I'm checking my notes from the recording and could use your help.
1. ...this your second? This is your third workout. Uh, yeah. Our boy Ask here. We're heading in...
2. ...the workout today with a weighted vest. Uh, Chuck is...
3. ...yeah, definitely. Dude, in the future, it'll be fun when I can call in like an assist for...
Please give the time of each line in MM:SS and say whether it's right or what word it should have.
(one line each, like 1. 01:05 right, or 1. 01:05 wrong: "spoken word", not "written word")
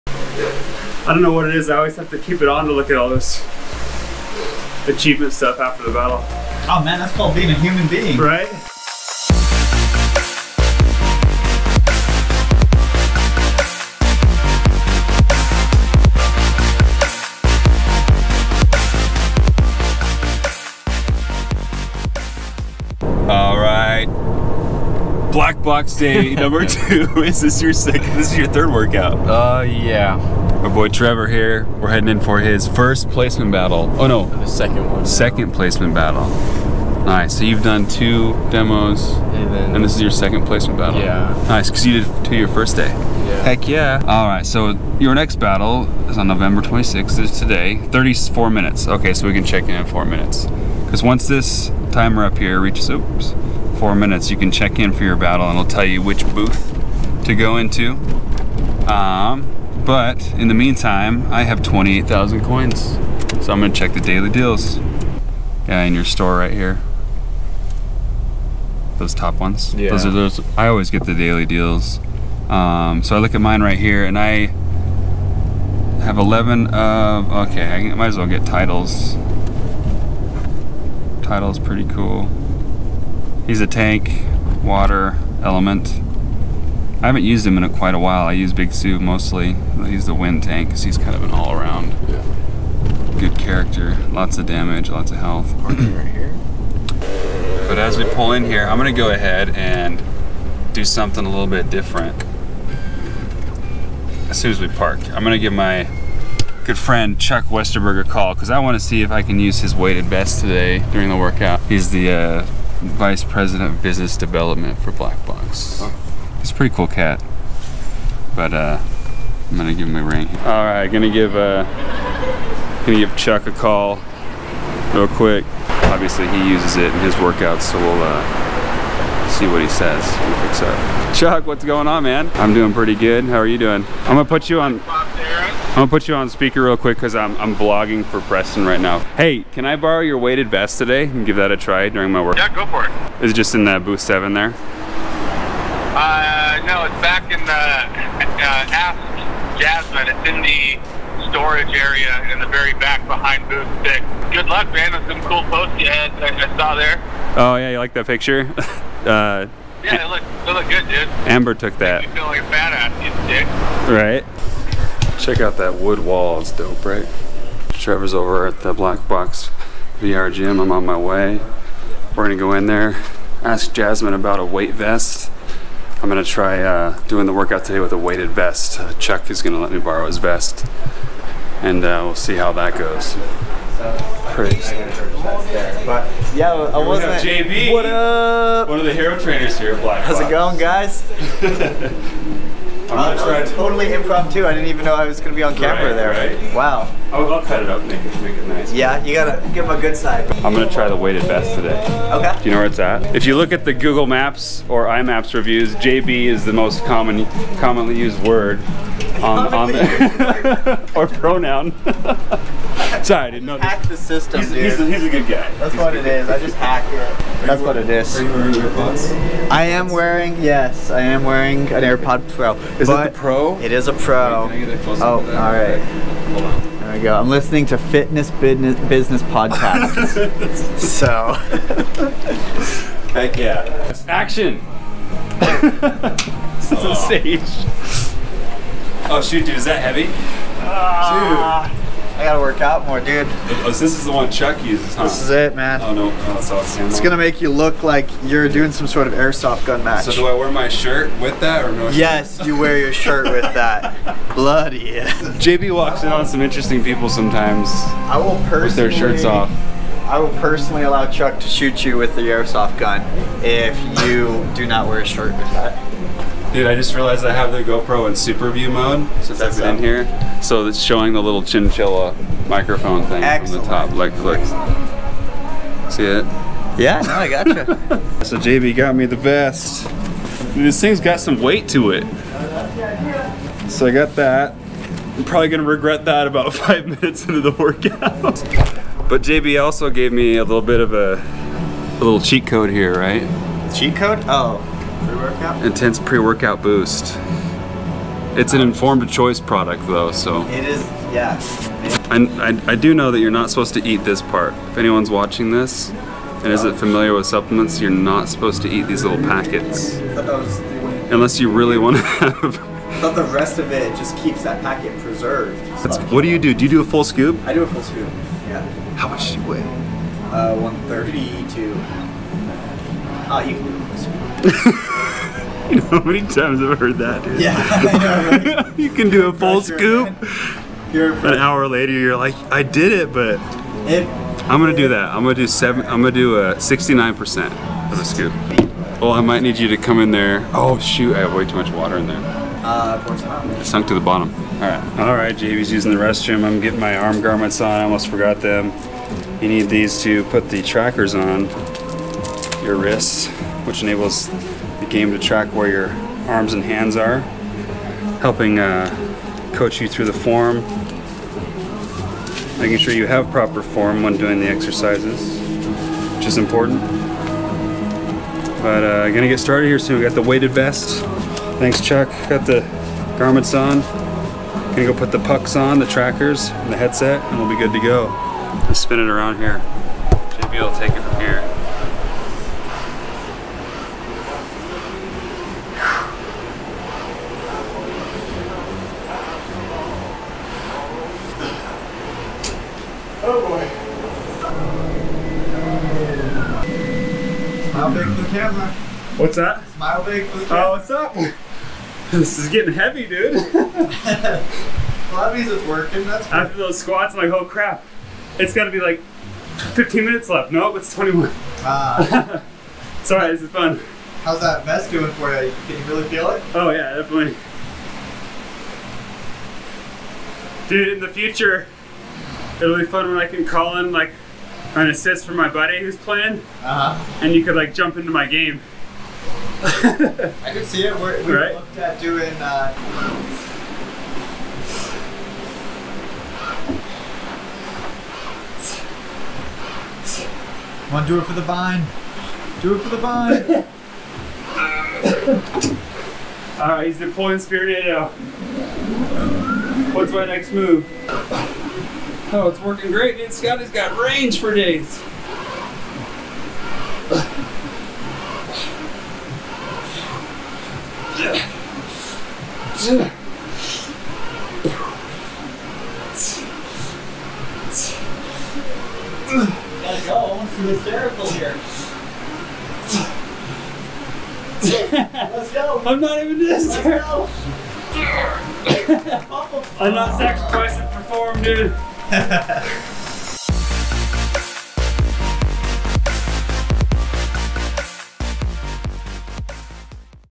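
1. 00:27 wrong: "Trevor", not "Ask"
2. 02:57 right
3. 06:56 right.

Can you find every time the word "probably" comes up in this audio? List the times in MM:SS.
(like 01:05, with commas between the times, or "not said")
04:45.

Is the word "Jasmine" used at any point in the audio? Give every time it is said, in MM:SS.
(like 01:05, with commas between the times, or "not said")
02:29, 02:53.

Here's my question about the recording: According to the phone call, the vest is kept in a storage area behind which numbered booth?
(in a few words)
booth 6.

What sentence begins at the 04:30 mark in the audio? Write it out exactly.
So it's showing the little chinchilla microphone thing Excellent.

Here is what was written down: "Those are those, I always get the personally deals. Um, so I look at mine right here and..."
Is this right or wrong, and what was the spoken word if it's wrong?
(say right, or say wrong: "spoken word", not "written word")
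wrong: "daily", not "personally".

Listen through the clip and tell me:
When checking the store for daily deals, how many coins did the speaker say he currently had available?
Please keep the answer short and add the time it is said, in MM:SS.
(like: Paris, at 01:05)
28,000, at 01:01.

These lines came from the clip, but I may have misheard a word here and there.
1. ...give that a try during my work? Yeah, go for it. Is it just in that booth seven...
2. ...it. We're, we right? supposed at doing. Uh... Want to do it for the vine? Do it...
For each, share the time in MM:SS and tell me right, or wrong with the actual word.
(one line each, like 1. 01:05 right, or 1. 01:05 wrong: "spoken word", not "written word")
1. 02:21 right
2. 07:10 wrong: "looked", not "supposed".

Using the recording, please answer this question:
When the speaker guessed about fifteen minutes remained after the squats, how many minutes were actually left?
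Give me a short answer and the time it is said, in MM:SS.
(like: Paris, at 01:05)
21, at 06:50.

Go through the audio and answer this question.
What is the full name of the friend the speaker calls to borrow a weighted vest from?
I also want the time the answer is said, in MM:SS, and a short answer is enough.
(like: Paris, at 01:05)
Chuck Westerberg, at 01:47.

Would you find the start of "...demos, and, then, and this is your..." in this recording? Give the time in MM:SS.
00:38.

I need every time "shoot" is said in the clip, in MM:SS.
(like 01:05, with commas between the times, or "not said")
03:59, 04:21, 05:40.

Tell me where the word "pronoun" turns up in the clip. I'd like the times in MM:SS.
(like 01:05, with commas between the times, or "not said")
03:31.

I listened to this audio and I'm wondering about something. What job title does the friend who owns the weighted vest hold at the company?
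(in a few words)
vice president of business development.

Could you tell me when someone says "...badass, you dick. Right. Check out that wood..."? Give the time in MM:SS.
02:42.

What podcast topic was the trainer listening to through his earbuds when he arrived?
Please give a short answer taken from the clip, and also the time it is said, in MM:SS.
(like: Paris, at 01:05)
fitness business, at 03:47.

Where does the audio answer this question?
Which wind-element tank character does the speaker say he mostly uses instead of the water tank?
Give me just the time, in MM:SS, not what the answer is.
01:28.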